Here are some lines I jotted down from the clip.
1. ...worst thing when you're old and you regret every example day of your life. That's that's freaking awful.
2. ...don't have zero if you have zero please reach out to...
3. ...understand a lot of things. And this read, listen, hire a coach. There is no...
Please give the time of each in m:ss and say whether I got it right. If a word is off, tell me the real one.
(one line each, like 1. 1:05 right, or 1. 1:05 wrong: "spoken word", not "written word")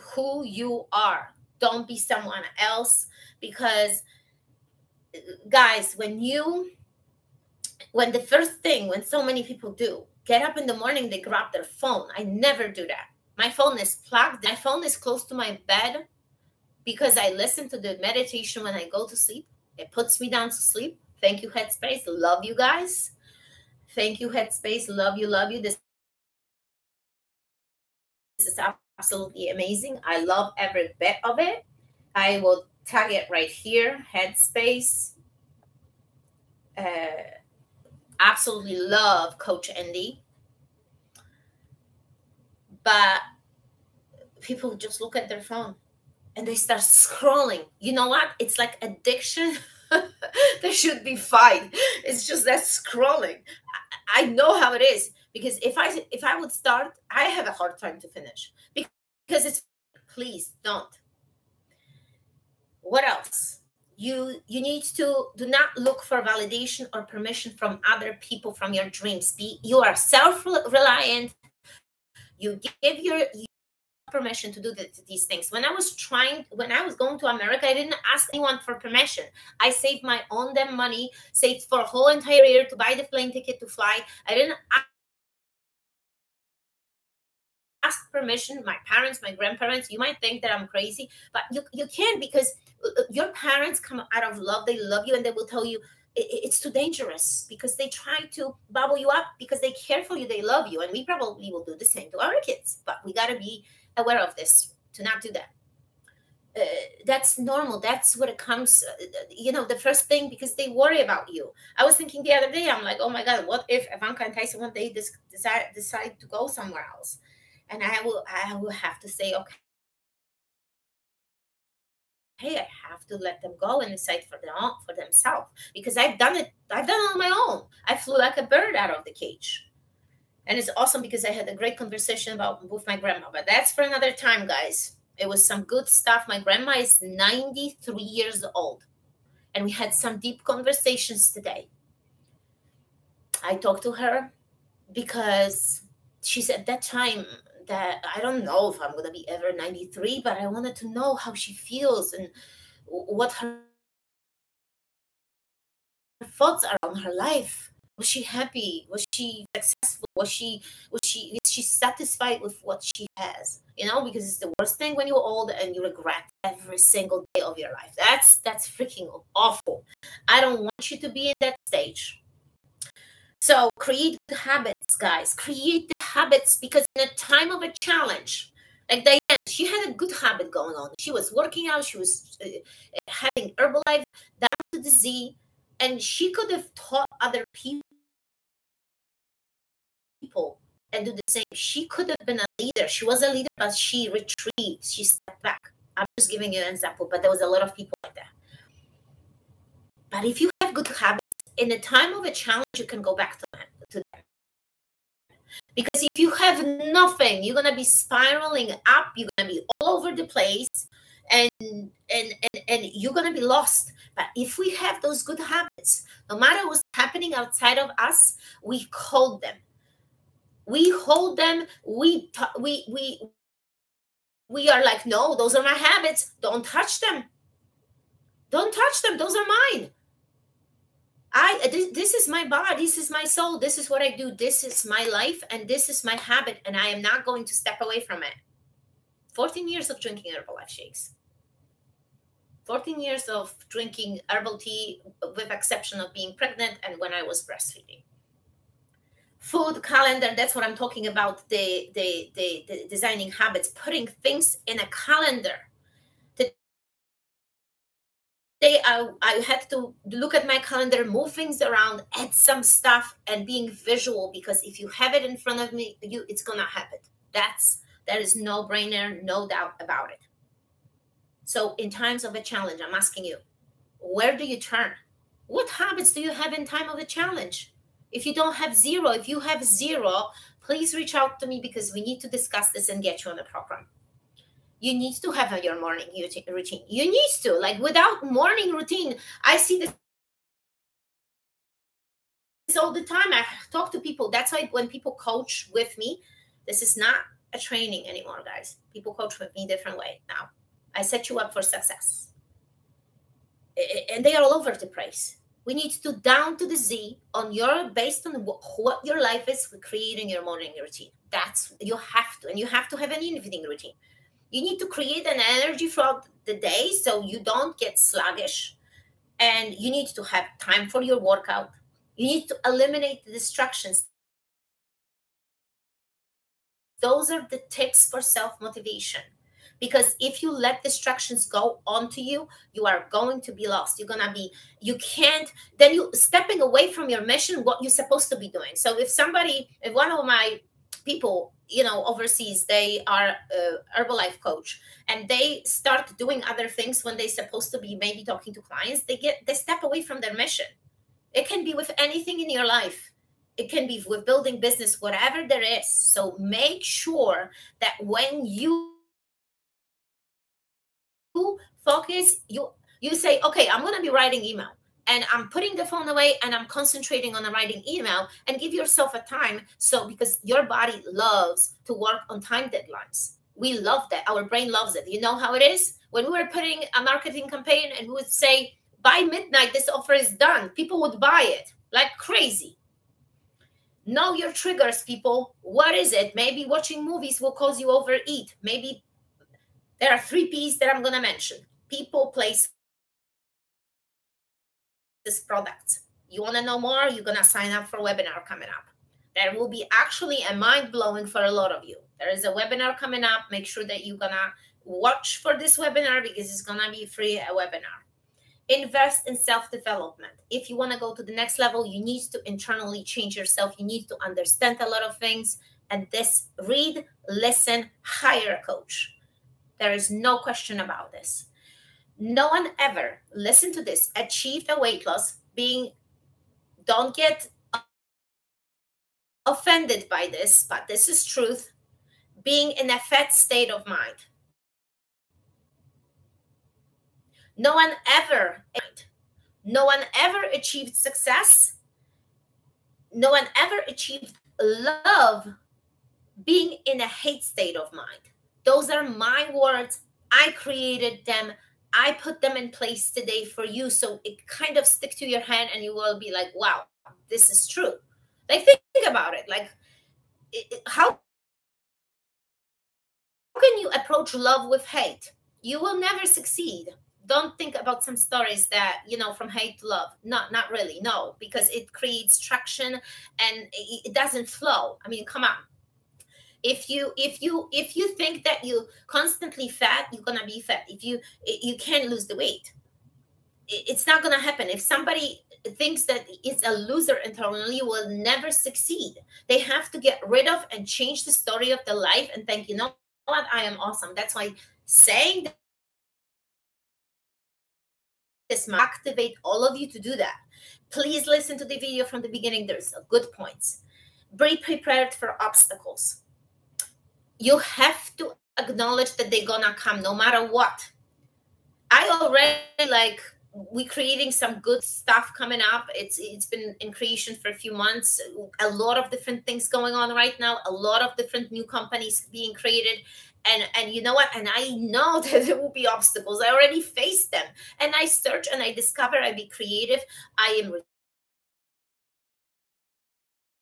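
1. 2:44 wrong: "single", not "example"
2. 4:38 right
3. 6:54 right.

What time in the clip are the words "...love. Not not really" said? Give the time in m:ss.
7:49.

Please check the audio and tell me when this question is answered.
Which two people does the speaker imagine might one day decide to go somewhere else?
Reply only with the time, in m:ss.
1:53.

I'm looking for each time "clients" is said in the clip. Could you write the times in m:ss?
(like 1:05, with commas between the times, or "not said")
5:48.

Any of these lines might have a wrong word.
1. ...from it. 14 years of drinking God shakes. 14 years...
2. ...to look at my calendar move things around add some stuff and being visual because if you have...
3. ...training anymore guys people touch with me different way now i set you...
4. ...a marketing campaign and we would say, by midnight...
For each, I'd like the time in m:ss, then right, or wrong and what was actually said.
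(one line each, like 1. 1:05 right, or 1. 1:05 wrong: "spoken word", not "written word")
1. 3:57 wrong: "Herbalife", not "God"
2. 4:19 right
3. 4:57 wrong: "coach", not "touch"
4. 6:16 right.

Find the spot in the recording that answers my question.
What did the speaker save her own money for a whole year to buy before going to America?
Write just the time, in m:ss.
1:23.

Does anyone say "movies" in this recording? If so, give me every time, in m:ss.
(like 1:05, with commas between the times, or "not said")
6:27.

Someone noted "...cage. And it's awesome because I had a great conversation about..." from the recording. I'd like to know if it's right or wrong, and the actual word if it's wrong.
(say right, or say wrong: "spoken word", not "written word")
right.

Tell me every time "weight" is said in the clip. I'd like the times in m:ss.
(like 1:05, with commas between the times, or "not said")
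7:04, 8:02.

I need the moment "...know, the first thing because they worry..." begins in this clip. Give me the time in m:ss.
1:49.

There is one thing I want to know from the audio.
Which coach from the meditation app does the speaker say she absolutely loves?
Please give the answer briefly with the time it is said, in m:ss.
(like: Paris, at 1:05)
Coach Andy, at 0:39.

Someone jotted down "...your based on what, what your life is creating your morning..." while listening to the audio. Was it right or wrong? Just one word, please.
right.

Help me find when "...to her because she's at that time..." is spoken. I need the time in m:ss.
2:23.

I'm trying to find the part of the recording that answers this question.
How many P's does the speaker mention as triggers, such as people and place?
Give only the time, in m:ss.
6:30.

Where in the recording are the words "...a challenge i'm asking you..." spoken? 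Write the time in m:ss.
4:32.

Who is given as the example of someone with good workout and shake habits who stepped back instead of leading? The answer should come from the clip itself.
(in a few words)
Diane.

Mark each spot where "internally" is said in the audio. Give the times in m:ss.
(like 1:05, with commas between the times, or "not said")
6:52, 8:07.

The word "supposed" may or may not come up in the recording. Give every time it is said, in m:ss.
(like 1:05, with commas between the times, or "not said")
5:38, 5:47.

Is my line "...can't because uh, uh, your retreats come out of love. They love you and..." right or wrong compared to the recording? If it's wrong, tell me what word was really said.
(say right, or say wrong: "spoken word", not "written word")
wrong: "parents", not "retreats".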